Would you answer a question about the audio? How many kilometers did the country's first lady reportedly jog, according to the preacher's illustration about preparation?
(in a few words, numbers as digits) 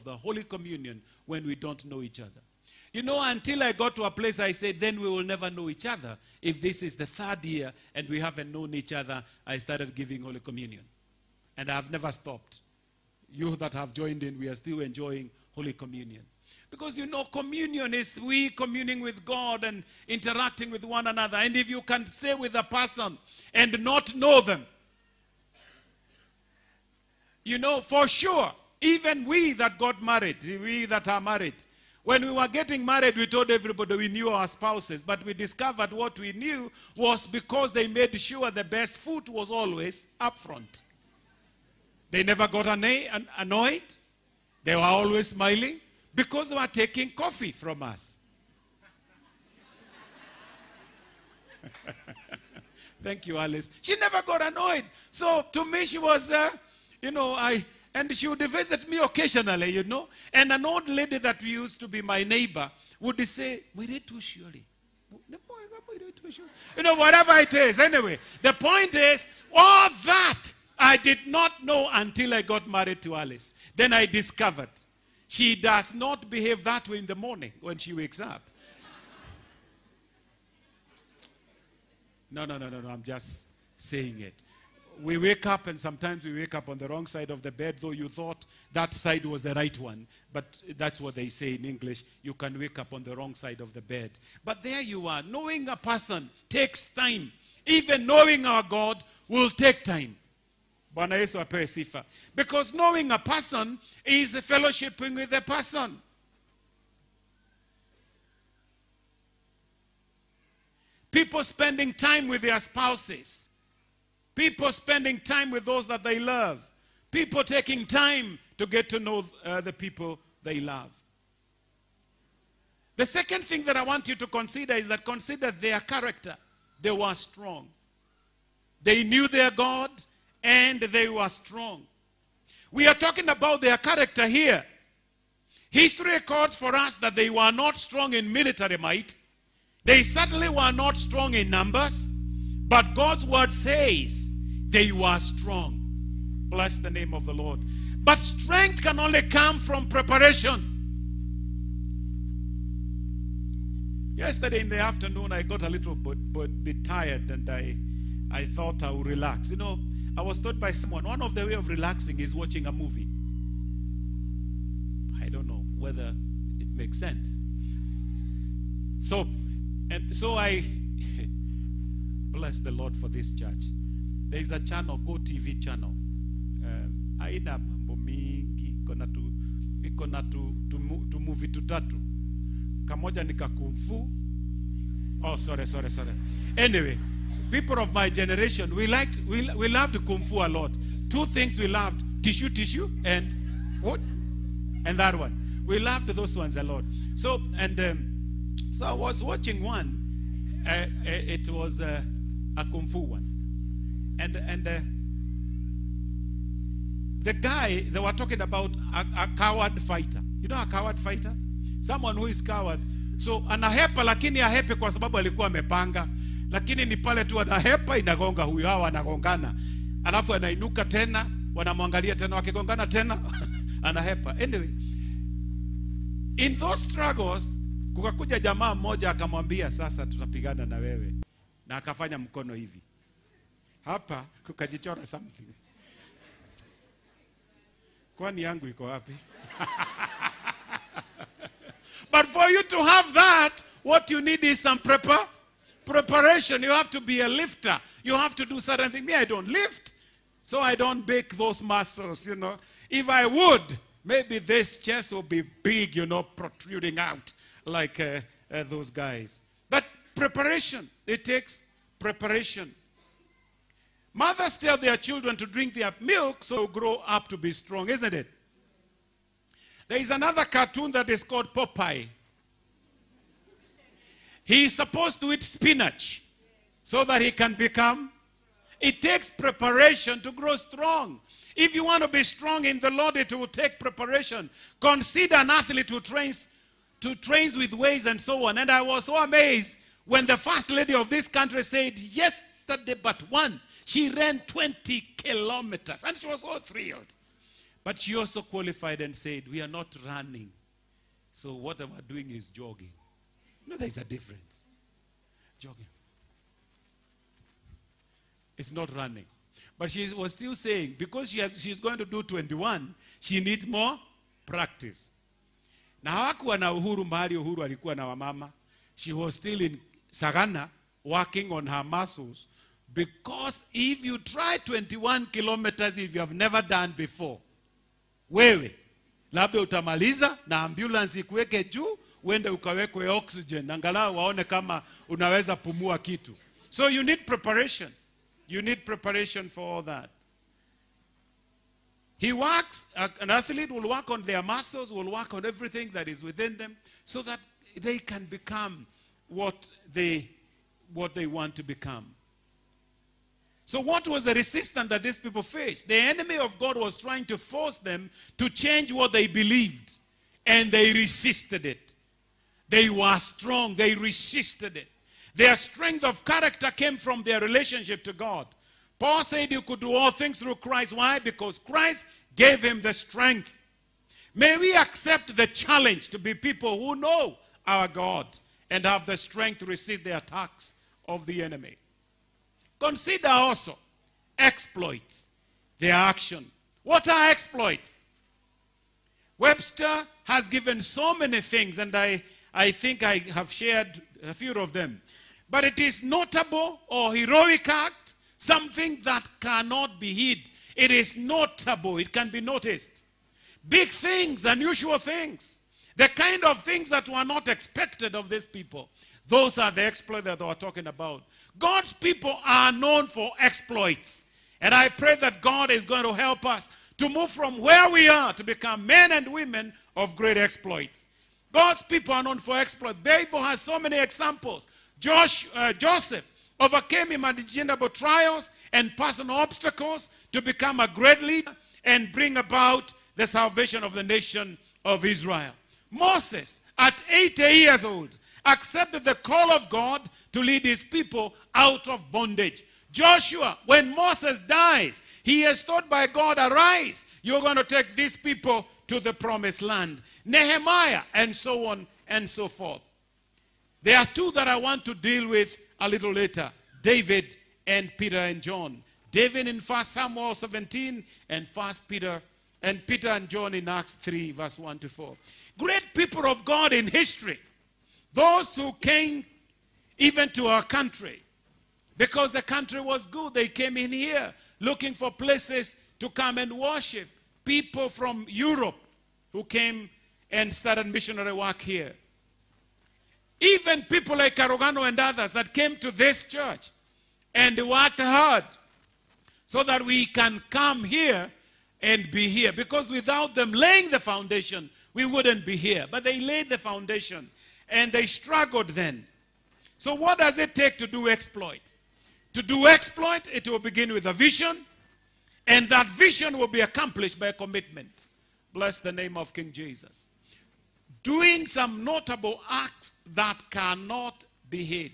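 20.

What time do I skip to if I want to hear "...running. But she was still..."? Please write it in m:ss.
5:08.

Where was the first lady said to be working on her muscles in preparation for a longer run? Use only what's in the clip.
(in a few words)
Sagana.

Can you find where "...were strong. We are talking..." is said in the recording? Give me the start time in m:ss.
2:11.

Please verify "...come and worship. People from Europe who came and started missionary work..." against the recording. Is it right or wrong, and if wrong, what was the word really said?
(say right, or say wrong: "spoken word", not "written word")
right.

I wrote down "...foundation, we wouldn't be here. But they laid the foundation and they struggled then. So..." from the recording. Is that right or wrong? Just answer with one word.
right.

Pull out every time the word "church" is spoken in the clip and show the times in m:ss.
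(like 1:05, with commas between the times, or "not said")
2:53, 8:06.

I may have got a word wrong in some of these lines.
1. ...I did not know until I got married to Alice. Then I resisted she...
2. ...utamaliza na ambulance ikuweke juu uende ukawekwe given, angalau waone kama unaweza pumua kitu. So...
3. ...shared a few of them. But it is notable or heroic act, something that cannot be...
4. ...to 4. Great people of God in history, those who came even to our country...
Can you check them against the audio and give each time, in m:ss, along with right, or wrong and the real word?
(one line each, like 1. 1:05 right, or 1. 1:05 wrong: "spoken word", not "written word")
1. 1:10 wrong: "discovered", not "resisted"
2. 5:29 wrong: "oxygen", not "given"
3. 6:33 right
4. 7:44 right.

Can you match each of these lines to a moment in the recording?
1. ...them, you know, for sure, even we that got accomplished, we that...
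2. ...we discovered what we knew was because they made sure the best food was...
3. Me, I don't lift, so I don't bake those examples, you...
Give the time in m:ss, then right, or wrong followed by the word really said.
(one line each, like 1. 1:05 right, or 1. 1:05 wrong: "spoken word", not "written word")
1. 0:24 wrong: "married", not "accomplished"
2. 0:35 right
3. 4:09 wrong: "muscles", not "examples".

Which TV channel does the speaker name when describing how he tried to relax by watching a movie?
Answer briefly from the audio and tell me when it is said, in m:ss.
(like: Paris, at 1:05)
Go TV, at 2:55.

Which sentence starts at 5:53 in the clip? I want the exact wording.
So, what was the resistance that these people faced?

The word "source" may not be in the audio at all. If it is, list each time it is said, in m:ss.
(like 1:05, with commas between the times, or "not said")
not said.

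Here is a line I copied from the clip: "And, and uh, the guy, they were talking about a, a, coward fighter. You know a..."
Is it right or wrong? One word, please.
right.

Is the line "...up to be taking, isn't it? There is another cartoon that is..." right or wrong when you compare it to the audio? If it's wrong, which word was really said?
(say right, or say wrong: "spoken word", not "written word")
wrong: "strong", not "taking".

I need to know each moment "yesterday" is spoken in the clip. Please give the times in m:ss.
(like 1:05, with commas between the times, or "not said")
2:34, 4:51.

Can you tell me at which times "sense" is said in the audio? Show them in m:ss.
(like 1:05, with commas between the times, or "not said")
2:46.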